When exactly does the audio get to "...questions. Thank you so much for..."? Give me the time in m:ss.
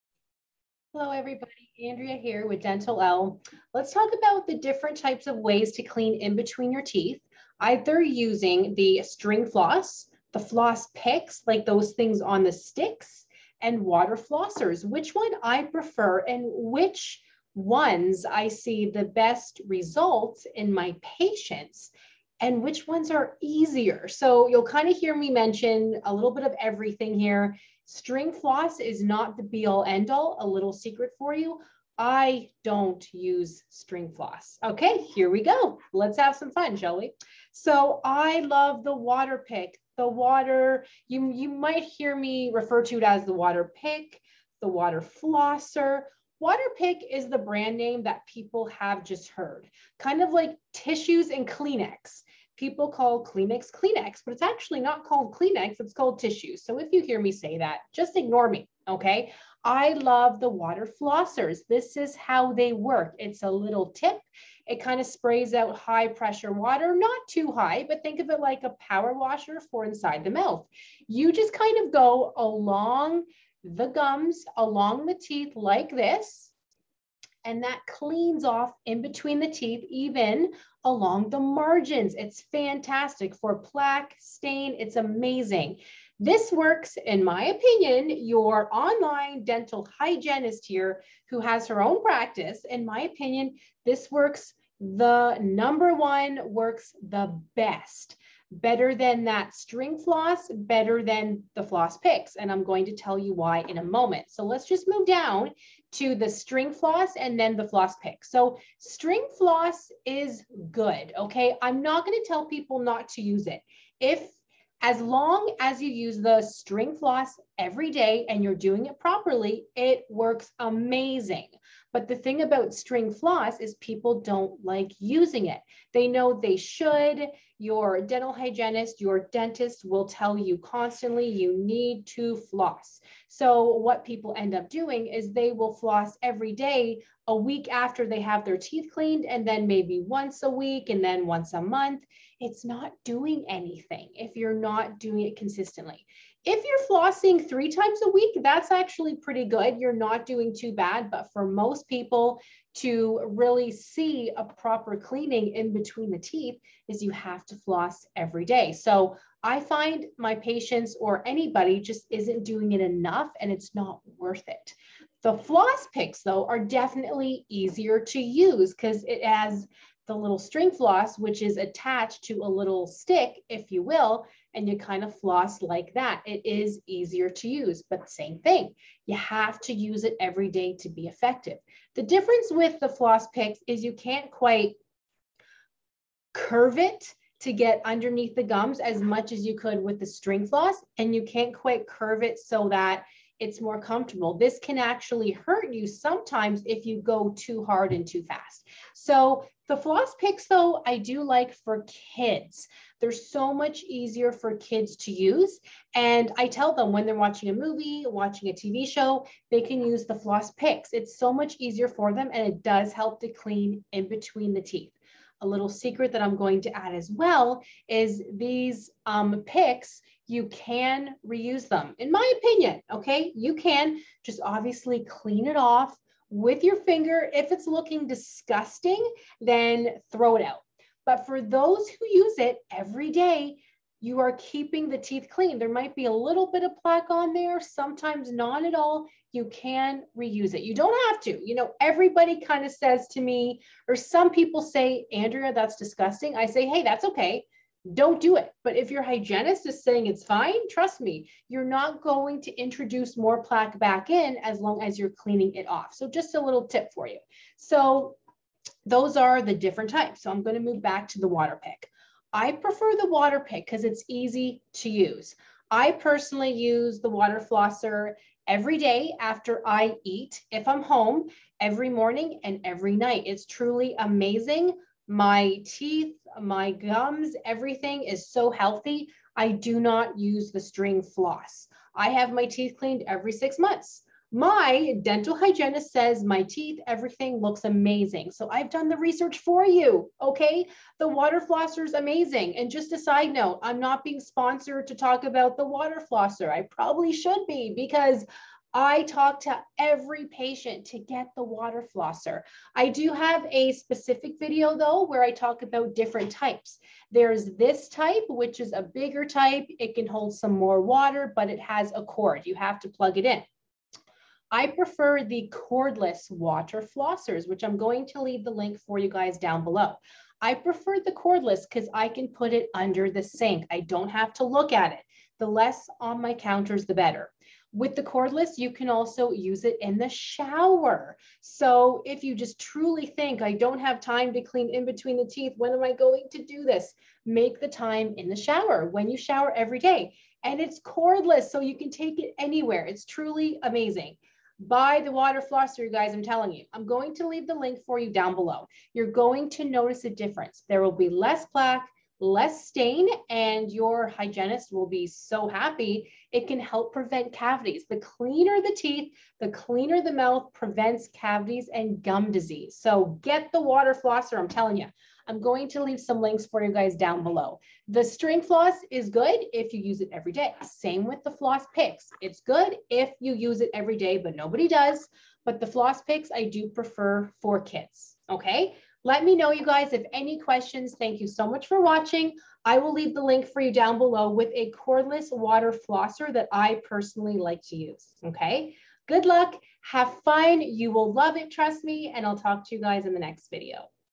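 6:20.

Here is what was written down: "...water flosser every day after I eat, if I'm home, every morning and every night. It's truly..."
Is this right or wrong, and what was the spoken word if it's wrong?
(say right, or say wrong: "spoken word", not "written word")
right.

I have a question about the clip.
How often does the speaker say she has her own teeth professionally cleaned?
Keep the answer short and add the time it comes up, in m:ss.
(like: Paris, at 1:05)
Every six months, at 4:43.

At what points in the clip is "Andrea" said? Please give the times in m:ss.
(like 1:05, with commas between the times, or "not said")
0:01, 4:05.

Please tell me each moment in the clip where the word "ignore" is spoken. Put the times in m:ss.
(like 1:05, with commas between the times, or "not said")
0:58.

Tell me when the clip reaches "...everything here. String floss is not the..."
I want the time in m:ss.
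0:26.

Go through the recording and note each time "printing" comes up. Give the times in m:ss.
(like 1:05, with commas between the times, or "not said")
not said.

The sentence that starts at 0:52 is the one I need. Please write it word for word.
People call Kleenex Kleenex, but it's actually not called Kleenex, it's called tissues.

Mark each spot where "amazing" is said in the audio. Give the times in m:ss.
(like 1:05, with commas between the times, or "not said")
1:24, 2:00, 4:33, 4:47, 4:51, 5:43.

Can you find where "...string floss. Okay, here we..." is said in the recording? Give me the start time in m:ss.
0:33.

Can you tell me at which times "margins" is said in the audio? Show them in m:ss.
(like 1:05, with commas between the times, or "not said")
1:21.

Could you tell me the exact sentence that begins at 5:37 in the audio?
Make the time in the shower when you shower every day.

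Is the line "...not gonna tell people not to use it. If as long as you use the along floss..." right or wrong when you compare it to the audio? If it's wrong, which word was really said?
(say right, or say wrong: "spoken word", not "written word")
wrong: "string", not "along".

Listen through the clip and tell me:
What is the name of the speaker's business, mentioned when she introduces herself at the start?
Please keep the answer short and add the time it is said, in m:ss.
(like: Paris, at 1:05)
Dentalelle, at 0:02.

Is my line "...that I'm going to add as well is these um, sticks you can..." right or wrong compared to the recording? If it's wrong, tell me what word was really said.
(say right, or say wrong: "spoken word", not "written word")
wrong: "picks", not "sticks".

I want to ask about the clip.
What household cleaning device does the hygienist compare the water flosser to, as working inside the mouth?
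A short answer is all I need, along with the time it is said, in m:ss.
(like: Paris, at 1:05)
A power washer, at 1:08.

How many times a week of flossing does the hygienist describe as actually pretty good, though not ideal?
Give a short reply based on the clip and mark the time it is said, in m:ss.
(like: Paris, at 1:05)
3, at 2:27.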